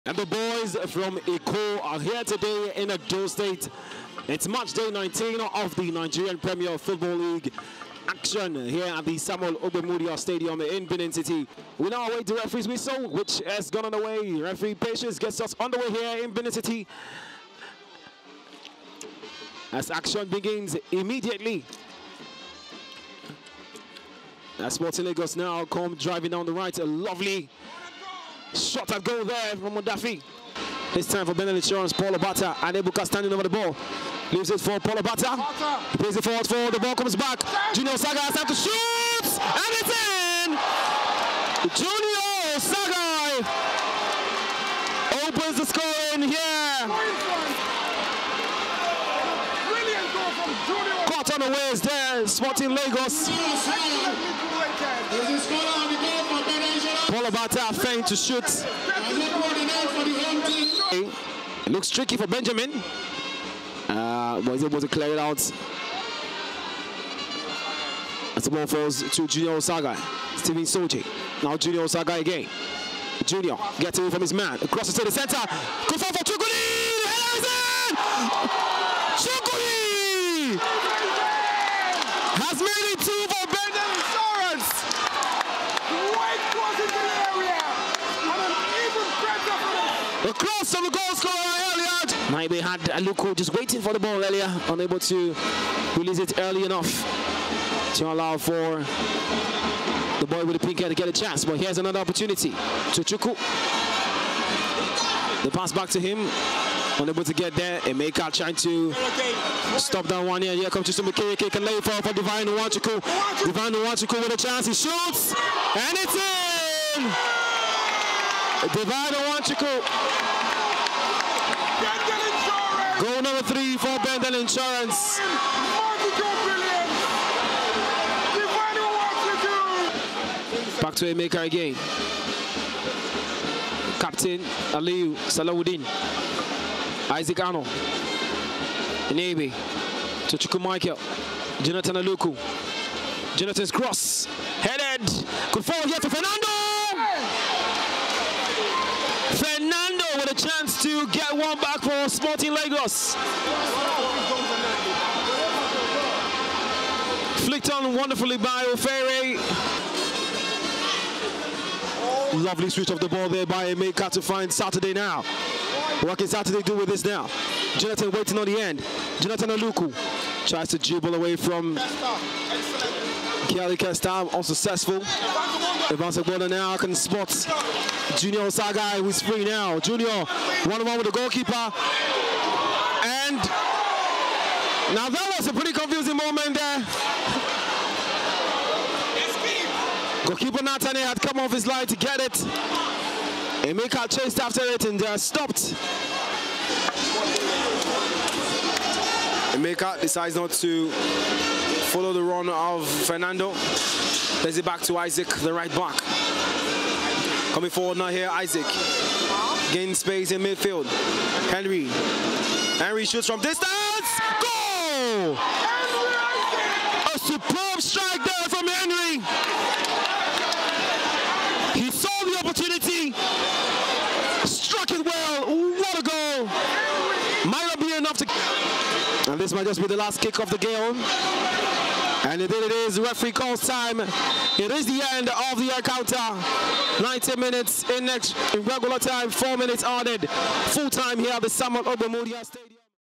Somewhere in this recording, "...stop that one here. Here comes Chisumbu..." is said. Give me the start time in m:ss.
1:49.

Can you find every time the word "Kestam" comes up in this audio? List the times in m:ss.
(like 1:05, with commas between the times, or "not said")
2:53.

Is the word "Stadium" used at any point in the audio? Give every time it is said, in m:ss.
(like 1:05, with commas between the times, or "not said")
0:10, 4:02.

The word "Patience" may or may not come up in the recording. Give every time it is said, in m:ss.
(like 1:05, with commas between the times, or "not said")
0:14.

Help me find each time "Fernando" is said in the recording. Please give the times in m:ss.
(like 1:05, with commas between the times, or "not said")
2:26, 3:23.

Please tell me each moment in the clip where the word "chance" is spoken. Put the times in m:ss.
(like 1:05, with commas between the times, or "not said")
1:41, 1:54.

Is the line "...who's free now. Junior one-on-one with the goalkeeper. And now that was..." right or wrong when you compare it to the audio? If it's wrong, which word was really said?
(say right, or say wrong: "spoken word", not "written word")
right.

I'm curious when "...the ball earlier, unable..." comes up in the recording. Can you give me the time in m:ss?
1:33.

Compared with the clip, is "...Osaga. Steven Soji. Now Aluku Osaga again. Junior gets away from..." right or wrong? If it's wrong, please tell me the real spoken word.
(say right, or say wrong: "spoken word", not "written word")
wrong: "Junior", not "Aluku".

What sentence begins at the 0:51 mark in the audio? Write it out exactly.
Caught on the waist there, Sporting Lagos.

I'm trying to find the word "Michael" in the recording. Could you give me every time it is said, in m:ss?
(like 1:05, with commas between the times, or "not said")
2:20.